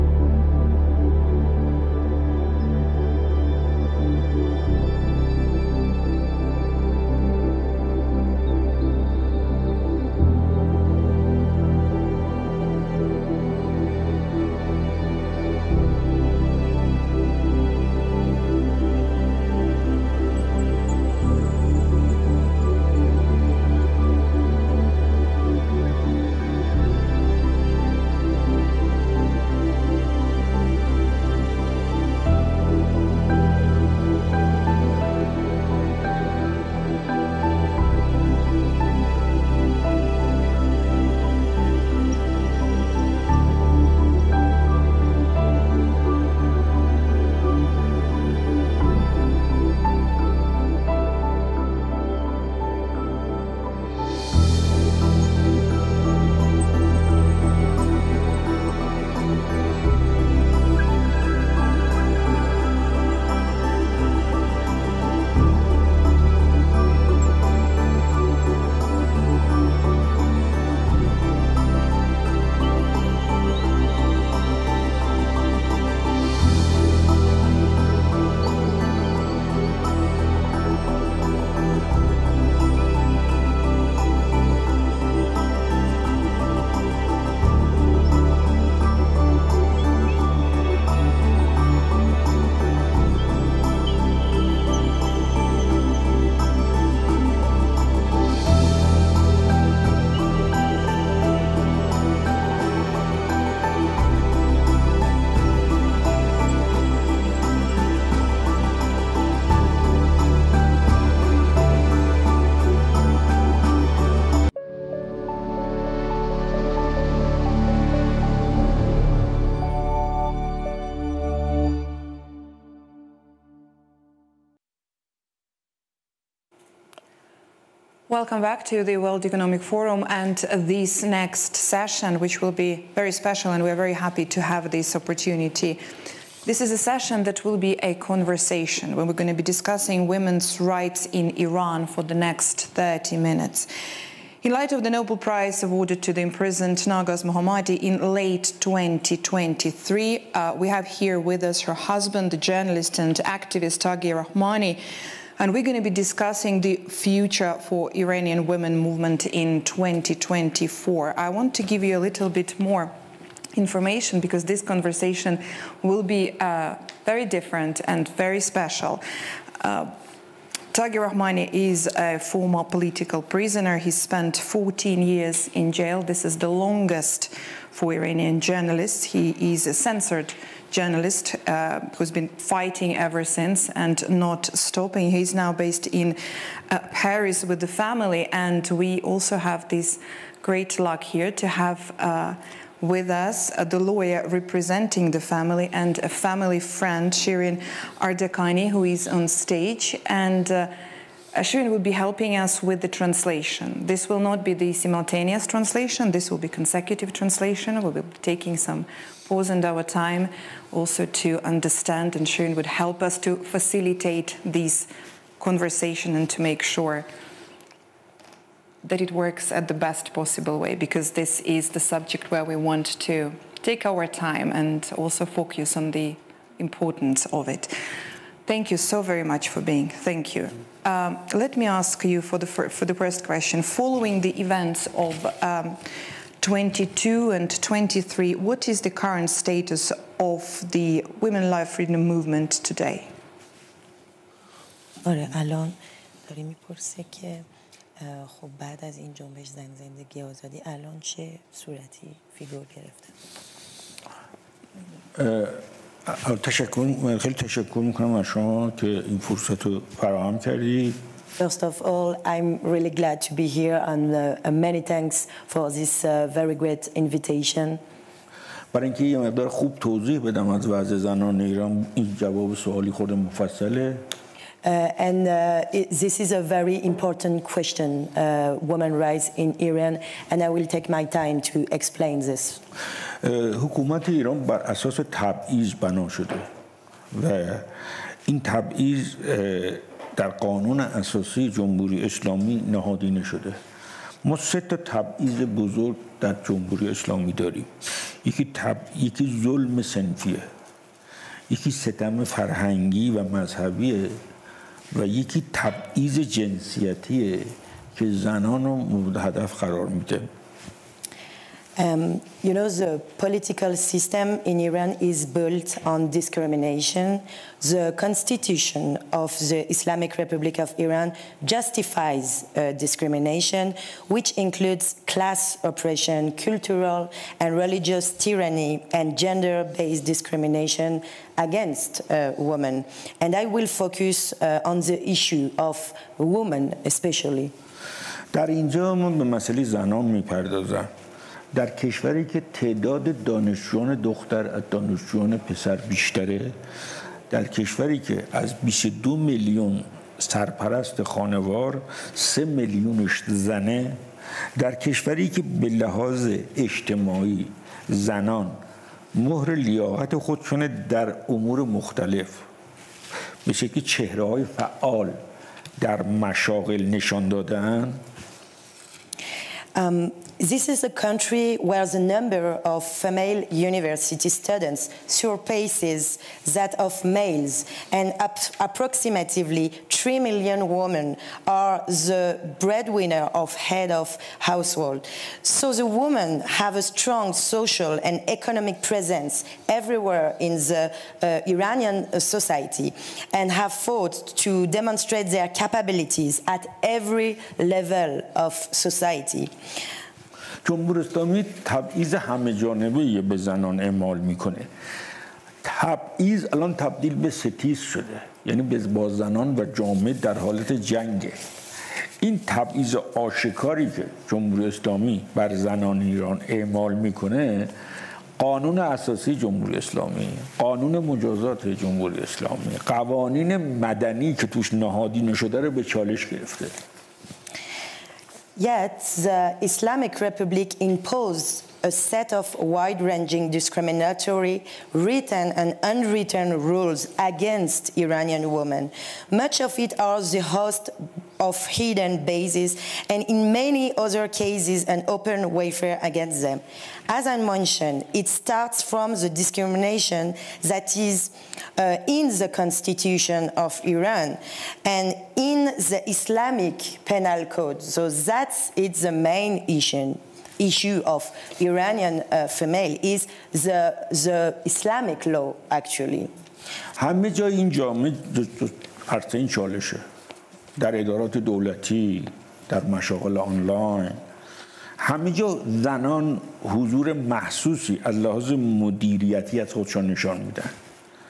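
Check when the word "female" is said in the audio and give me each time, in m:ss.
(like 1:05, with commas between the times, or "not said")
6:12, 7:42.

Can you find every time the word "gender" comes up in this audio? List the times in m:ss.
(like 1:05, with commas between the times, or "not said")
5:29.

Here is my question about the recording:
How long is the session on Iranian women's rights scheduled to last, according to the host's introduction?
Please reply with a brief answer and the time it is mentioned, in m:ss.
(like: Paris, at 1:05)
30 minutes, at 2:22.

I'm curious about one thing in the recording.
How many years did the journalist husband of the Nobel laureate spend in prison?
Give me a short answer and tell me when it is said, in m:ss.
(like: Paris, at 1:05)
14 years, at 2:54.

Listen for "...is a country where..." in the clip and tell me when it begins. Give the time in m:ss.
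6:10.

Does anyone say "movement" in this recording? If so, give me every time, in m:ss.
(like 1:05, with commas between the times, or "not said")
2:38, 4:02.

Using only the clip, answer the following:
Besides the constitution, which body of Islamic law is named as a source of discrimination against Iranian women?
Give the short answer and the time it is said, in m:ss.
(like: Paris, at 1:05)
Islamic penal code, at 7:36.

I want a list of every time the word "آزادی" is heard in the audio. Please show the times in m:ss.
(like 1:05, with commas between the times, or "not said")
4:10.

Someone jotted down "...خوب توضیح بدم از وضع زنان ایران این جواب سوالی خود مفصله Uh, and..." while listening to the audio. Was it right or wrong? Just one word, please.
right.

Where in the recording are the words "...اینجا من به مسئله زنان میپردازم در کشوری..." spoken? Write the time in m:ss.
5:38.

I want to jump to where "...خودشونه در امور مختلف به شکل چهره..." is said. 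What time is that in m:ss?
6:00.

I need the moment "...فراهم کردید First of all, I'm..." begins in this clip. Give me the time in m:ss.
4:19.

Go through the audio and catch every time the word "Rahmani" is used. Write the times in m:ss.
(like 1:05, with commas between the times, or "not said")
2:34, 2:51.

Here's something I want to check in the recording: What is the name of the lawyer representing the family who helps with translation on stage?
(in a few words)
Shirin Ardakani.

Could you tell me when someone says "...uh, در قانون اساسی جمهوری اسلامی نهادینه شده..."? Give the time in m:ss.
4:49.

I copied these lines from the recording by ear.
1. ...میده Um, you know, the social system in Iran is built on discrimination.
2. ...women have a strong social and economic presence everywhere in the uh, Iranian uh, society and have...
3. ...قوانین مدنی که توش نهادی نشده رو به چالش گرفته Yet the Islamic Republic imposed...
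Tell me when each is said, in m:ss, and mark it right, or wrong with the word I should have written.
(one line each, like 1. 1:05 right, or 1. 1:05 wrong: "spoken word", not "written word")
1. 5:09 wrong: "political", not "social"
2. 6:25 right
3. 7:02 right.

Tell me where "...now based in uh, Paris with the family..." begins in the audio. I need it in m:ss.
3:05.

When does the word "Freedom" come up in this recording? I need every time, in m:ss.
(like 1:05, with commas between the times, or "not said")
4:01.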